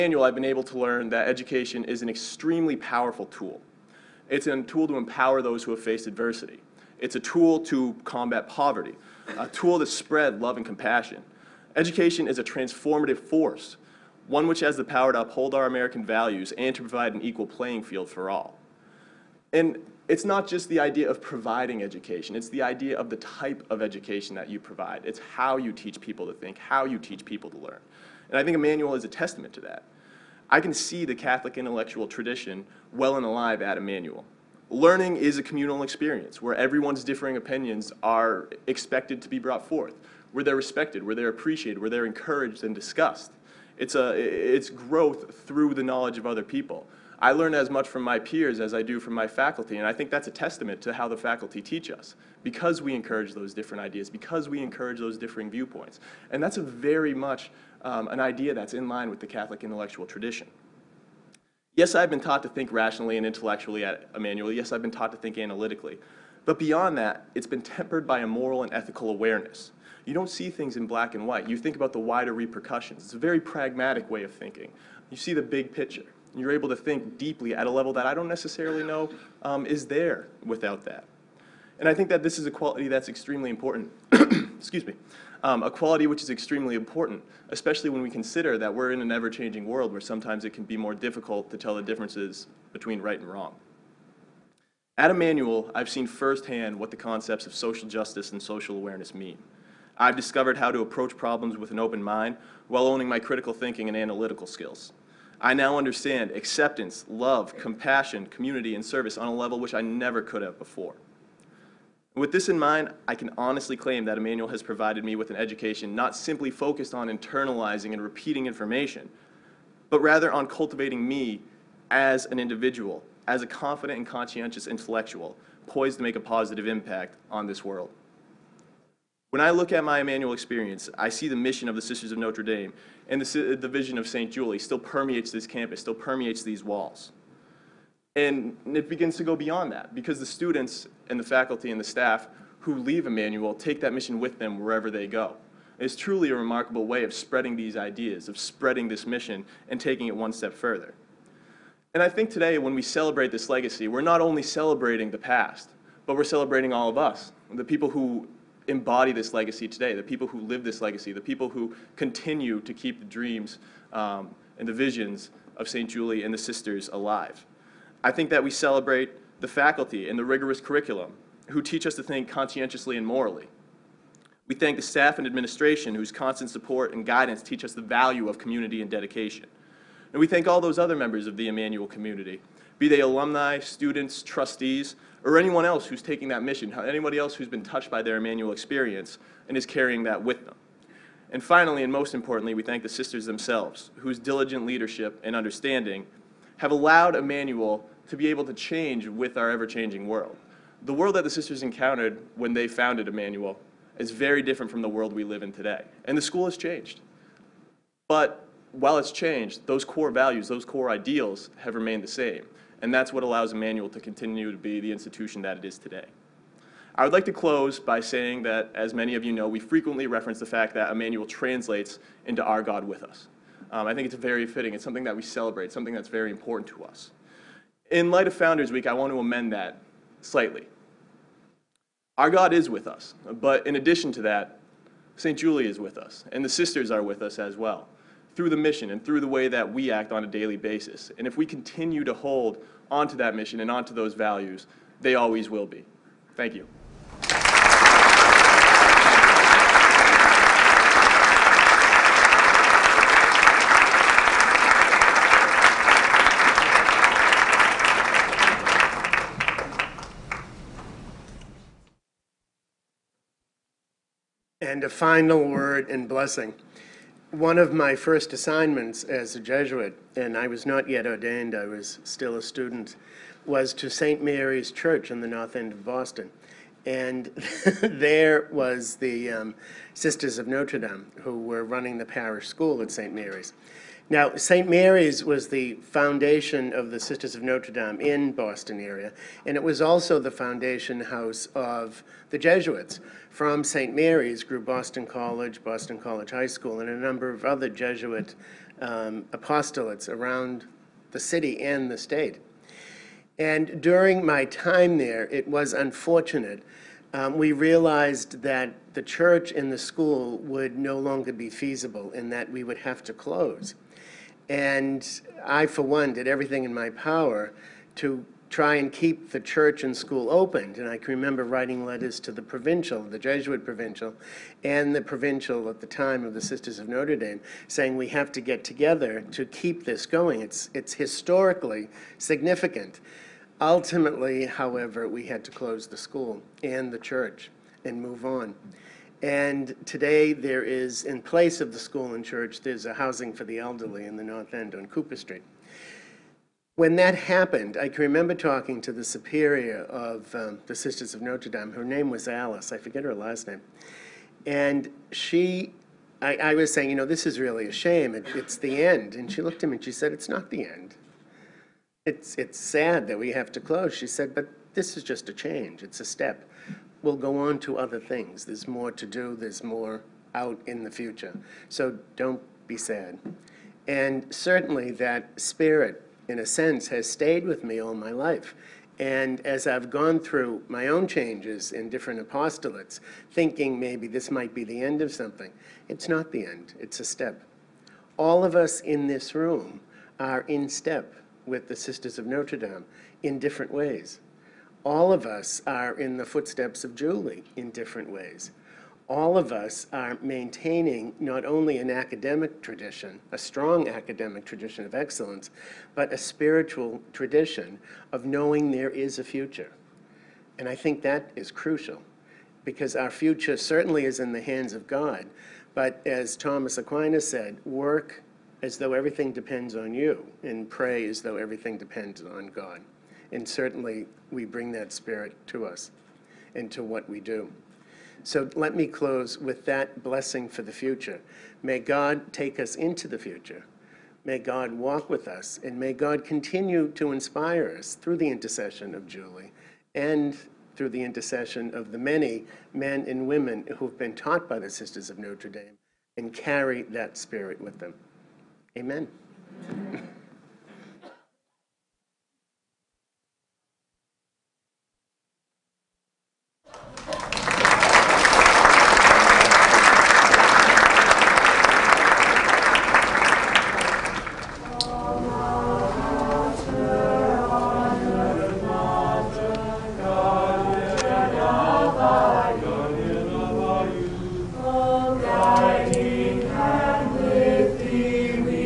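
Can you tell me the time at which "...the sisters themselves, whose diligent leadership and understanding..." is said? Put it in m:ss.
3:12.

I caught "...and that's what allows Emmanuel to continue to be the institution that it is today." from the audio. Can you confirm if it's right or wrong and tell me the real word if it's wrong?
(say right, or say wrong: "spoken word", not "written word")
right.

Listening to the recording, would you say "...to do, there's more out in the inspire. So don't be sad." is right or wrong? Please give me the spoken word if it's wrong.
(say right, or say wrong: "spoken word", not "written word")
wrong: "future", not "inspire".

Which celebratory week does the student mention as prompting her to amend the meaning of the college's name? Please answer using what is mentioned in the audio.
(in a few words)
Founders Week.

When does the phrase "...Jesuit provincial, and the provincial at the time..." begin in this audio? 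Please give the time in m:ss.
5:23.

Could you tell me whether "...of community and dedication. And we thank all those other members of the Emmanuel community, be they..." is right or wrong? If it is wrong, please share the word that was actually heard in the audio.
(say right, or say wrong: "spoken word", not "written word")
right.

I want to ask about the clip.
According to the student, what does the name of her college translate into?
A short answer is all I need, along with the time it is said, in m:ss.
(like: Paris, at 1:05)
God with us, at 3:42.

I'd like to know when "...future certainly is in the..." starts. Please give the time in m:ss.
6:53.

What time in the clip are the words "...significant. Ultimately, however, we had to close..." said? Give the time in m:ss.
5:32.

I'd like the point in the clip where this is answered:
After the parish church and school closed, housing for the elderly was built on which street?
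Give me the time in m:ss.
5:44.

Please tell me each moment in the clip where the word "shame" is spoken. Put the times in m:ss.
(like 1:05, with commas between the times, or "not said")
5:57.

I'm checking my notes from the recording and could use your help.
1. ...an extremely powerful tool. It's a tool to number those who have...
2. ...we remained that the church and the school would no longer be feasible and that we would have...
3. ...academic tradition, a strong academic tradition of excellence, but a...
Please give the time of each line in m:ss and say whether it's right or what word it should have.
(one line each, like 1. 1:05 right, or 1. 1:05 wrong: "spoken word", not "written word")
1. 0:02 wrong: "empower", not "number"
2. 5:07 wrong: "realized", not "remained"
3. 6:41 right.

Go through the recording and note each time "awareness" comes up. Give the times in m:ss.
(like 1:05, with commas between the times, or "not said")
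1:09, 1:38.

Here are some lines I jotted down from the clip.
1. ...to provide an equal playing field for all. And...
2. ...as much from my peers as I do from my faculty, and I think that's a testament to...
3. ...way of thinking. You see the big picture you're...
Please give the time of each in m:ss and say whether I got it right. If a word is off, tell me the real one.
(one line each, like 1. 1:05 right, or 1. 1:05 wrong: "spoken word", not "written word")
1. 0:16 right
2. 0:47 right
3. 1:14 right.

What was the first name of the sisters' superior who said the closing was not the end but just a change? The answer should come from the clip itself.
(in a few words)
Alice.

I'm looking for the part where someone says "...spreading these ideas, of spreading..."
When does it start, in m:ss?
2:27.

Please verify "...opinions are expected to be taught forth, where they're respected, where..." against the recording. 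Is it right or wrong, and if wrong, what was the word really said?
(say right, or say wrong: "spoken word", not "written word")
wrong: "brought", not "taught".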